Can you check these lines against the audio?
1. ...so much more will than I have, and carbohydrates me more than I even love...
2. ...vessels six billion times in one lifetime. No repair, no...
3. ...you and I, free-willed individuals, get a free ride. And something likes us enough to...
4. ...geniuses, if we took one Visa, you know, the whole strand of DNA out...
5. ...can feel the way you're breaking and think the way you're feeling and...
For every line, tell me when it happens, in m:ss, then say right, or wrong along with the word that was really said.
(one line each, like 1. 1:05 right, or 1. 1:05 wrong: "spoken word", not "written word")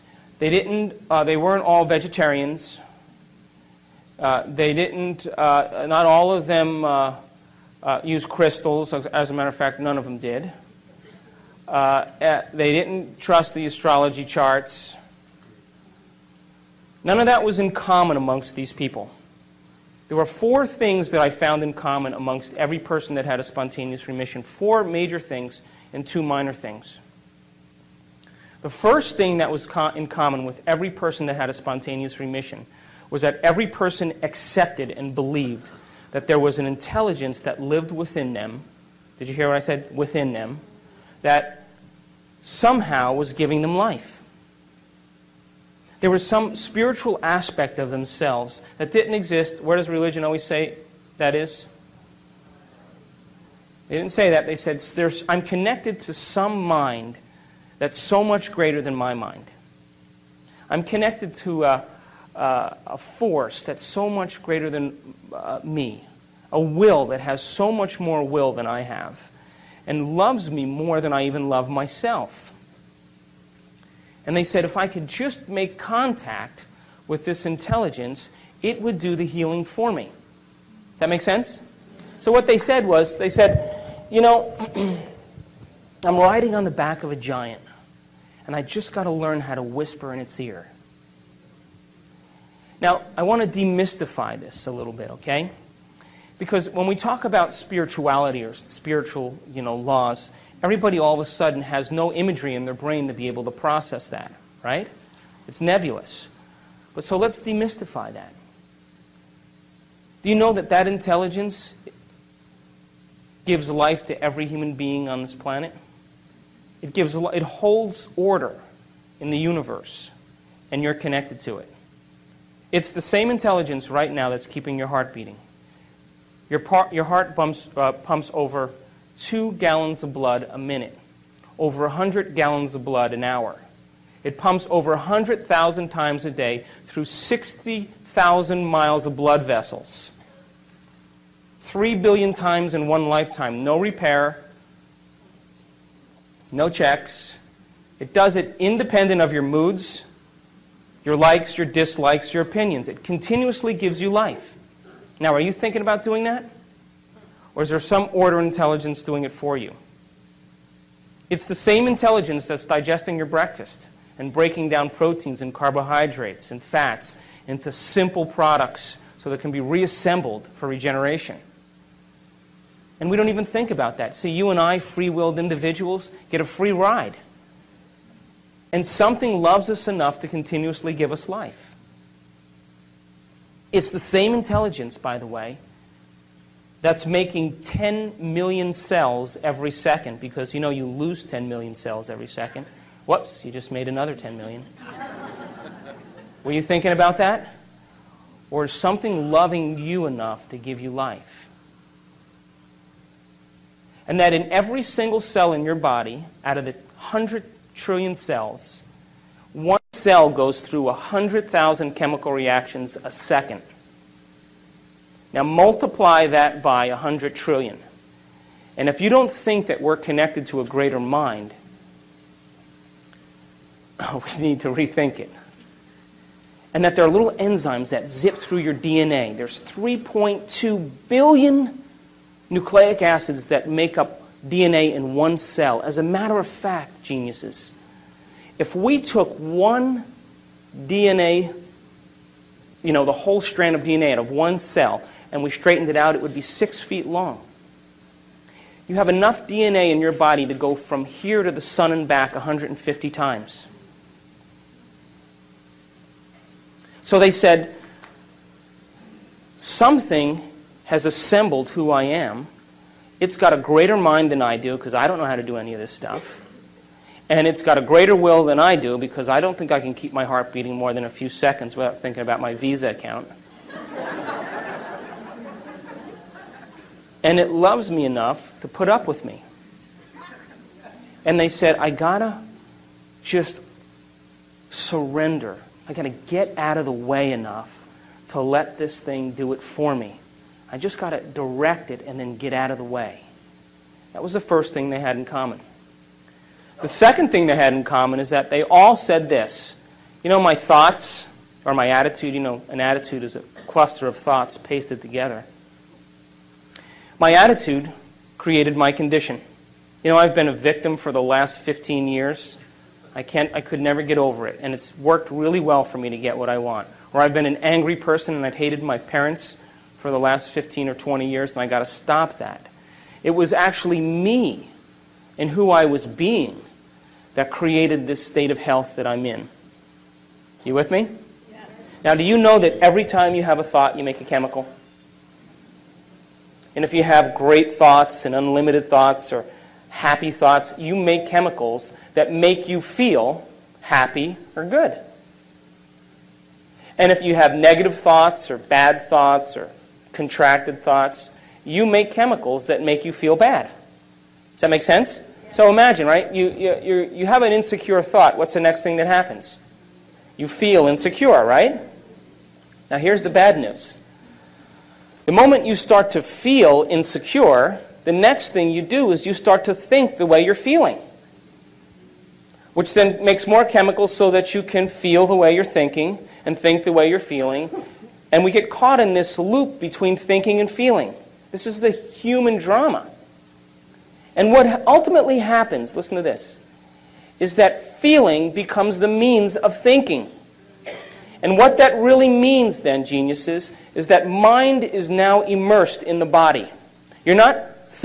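1. 1:07 wrong: "loves", not "carbohydrates"
2. 2:19 wrong: "three", not "six"
3. 2:54 wrong: "loves", not "likes"
4. 3:57 wrong: "DNA", not "Visa"
5. 6:14 wrong: "thinking", not "breaking".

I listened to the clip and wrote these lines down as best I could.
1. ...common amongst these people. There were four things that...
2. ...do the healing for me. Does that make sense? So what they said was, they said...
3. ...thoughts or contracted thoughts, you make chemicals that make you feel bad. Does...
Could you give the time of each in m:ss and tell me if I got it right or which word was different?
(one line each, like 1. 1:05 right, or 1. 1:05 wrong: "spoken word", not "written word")
1. 0:17 right
2. 1:18 right
3. 5:49 right.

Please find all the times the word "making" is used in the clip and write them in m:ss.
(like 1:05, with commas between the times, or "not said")
3:07.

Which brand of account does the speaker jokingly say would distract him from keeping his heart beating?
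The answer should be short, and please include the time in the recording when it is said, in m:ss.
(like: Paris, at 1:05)
Visa, at 4:32.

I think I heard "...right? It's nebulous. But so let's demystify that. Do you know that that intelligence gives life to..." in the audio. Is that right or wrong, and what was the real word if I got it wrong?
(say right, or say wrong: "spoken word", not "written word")
right.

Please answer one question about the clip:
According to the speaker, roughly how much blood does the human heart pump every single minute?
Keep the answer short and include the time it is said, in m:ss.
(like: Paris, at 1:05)
2 gallons, at 2:09.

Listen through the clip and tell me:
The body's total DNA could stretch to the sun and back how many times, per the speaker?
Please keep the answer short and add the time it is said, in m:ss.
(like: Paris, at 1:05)
150 times, at 4:12.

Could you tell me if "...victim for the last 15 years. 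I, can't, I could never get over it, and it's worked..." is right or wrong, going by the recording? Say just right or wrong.
right.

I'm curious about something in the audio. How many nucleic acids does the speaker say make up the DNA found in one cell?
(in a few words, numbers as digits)
3.2 billion.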